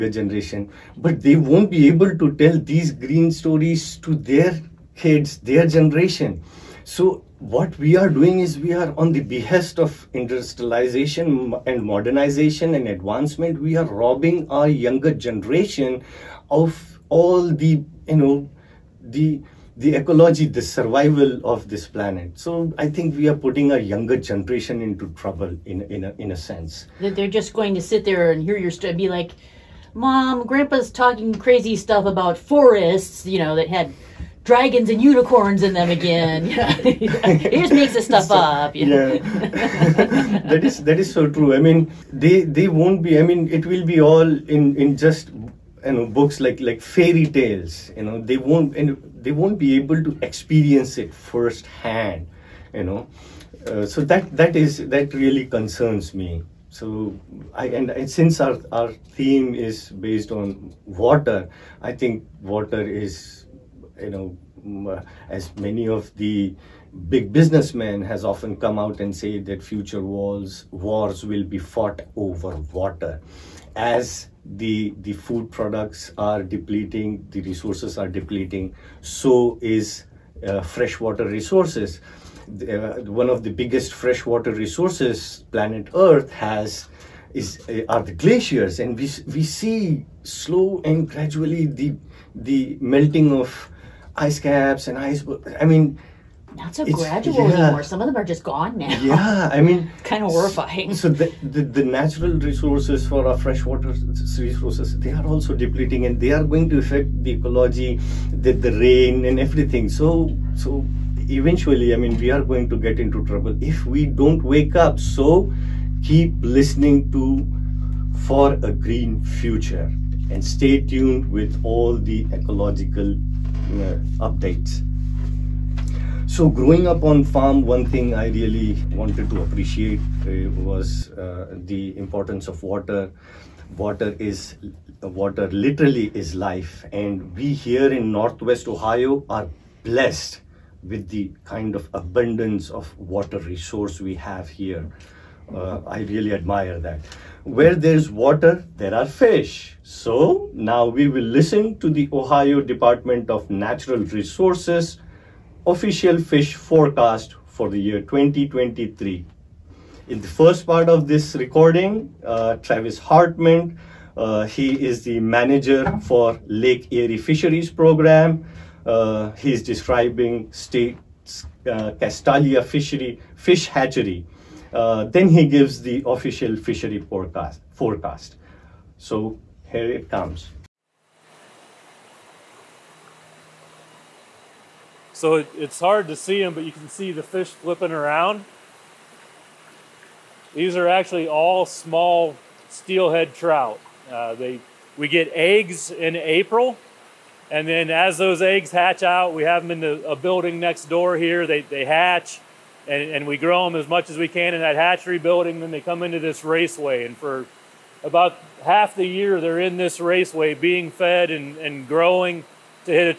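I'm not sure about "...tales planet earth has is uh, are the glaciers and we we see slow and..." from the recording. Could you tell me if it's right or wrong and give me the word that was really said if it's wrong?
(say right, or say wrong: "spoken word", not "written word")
wrong: "resources", not "tales".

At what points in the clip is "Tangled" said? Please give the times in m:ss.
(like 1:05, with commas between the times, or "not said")
not said.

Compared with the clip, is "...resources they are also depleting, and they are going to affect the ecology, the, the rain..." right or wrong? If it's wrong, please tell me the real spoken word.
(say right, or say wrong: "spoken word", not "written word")
right.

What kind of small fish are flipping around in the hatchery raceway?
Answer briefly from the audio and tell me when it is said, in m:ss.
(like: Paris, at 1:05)
Steelhead trout, at 3:12.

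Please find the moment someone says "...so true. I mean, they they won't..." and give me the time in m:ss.
0:41.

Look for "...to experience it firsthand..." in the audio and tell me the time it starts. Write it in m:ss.
0:50.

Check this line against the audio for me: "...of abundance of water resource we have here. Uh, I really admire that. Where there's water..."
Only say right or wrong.
right.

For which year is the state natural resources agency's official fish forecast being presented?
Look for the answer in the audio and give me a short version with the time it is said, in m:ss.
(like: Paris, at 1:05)
2023, at 2:37.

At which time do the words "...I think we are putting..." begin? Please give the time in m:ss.
0:22.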